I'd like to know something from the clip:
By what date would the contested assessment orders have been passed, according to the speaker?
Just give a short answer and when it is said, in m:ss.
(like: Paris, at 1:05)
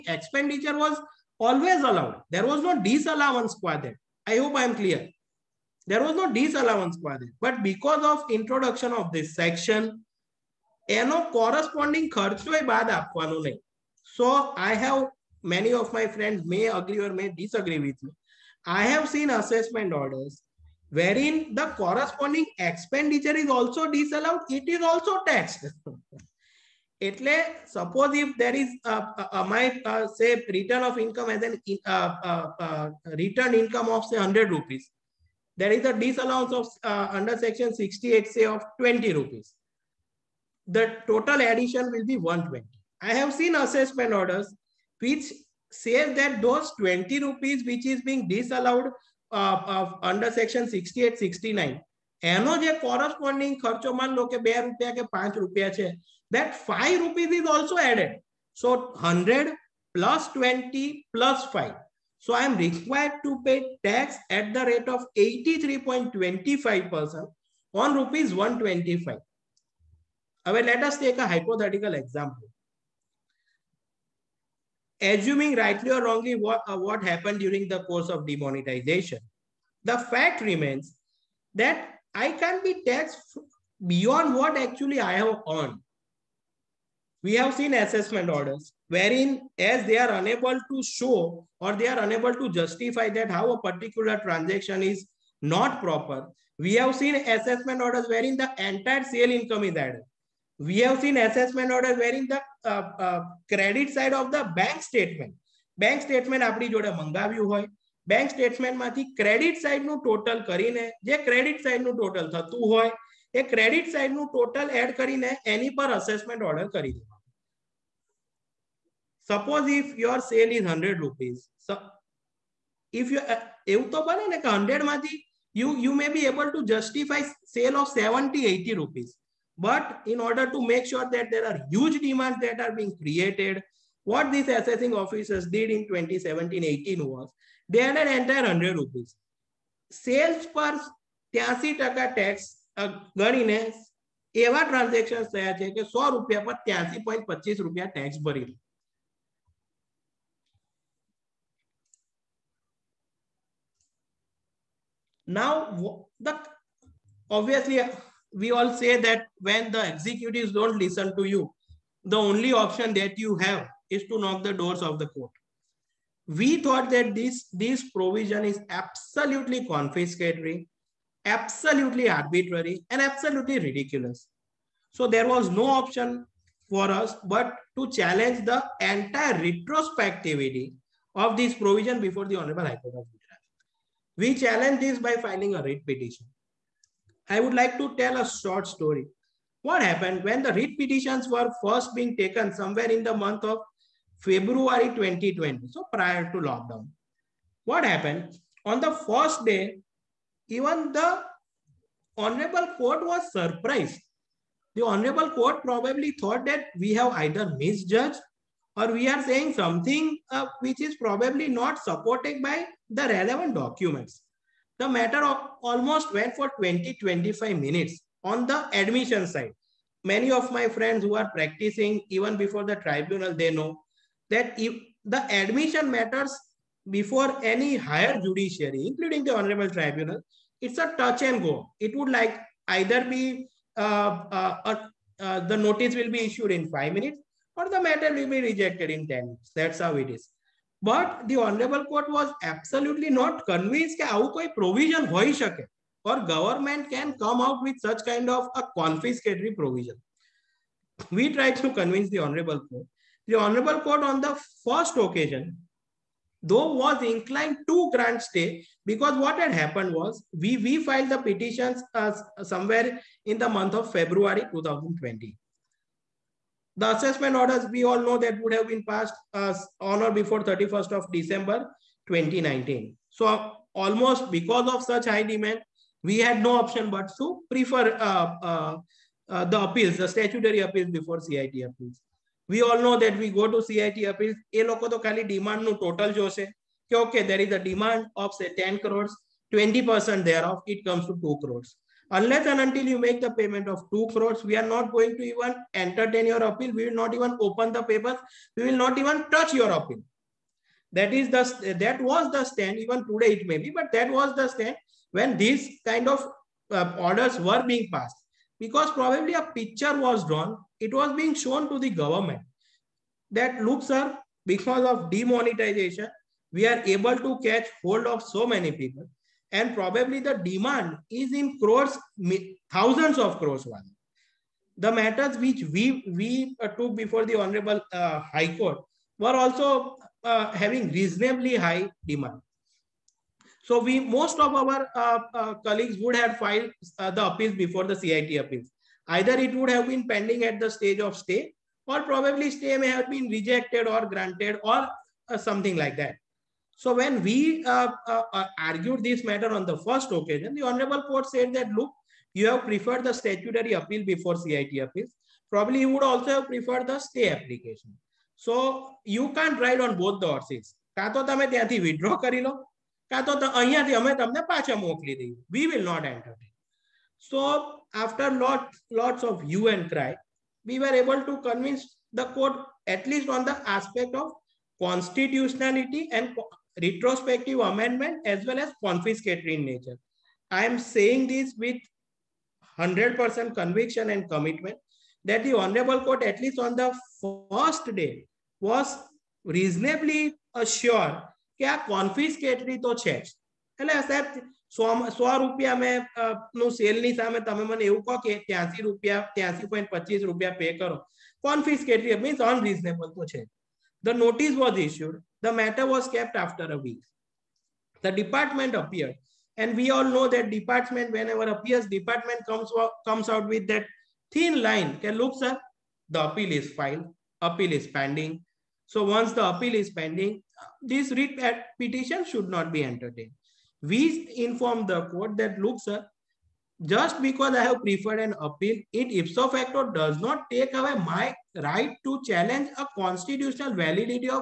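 31st December 2019, at 4:30.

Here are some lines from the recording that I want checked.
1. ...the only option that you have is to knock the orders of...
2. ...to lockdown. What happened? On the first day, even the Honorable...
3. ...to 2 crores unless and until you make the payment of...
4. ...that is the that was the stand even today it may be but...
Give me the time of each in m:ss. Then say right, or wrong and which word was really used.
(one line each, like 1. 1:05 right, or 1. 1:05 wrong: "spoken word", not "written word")
1. 2:42 wrong: "doors", not "orders"
2. 3:16 right
3. 4:51 right
4. 5:00 right.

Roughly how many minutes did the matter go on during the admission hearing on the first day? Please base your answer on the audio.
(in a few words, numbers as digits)
20-25 minutes.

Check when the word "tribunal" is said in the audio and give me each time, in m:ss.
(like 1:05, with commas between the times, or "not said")
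3:42, 3:49.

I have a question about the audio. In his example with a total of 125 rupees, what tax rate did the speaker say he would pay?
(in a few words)
83.25%.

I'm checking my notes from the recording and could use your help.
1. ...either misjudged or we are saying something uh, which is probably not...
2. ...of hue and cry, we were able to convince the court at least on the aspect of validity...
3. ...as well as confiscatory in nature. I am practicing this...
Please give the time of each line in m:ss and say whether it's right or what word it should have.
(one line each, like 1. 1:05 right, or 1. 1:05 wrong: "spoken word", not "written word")
1. 3:27 right
2. 6:09 wrong: "constitutionality", not "validity"
3. 6:18 wrong: "saying", not "practicing".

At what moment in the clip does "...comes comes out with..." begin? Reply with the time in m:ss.
6:52.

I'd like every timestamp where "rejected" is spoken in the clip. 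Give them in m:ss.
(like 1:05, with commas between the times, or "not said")
3:58, 5:43.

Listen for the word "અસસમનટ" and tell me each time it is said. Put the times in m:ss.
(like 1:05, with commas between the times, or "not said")
0:19, 1:55.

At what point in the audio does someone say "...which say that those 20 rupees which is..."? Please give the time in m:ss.
0:44.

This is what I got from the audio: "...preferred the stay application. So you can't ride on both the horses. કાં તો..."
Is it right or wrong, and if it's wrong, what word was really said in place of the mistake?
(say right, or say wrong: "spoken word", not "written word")
right.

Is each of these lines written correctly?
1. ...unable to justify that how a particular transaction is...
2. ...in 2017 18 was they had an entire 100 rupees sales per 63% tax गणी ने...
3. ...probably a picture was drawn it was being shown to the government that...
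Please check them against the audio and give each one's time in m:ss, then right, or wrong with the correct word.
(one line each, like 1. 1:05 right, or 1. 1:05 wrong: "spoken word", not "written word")
1. 1:31 right
2. 2:15 wrong: "83", not "63"
3. 5:09 right.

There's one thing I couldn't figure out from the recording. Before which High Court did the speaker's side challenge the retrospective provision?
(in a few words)
Gujarat.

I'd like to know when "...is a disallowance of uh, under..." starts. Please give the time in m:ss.
0:35.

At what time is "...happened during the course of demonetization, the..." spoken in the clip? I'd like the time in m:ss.
1:17.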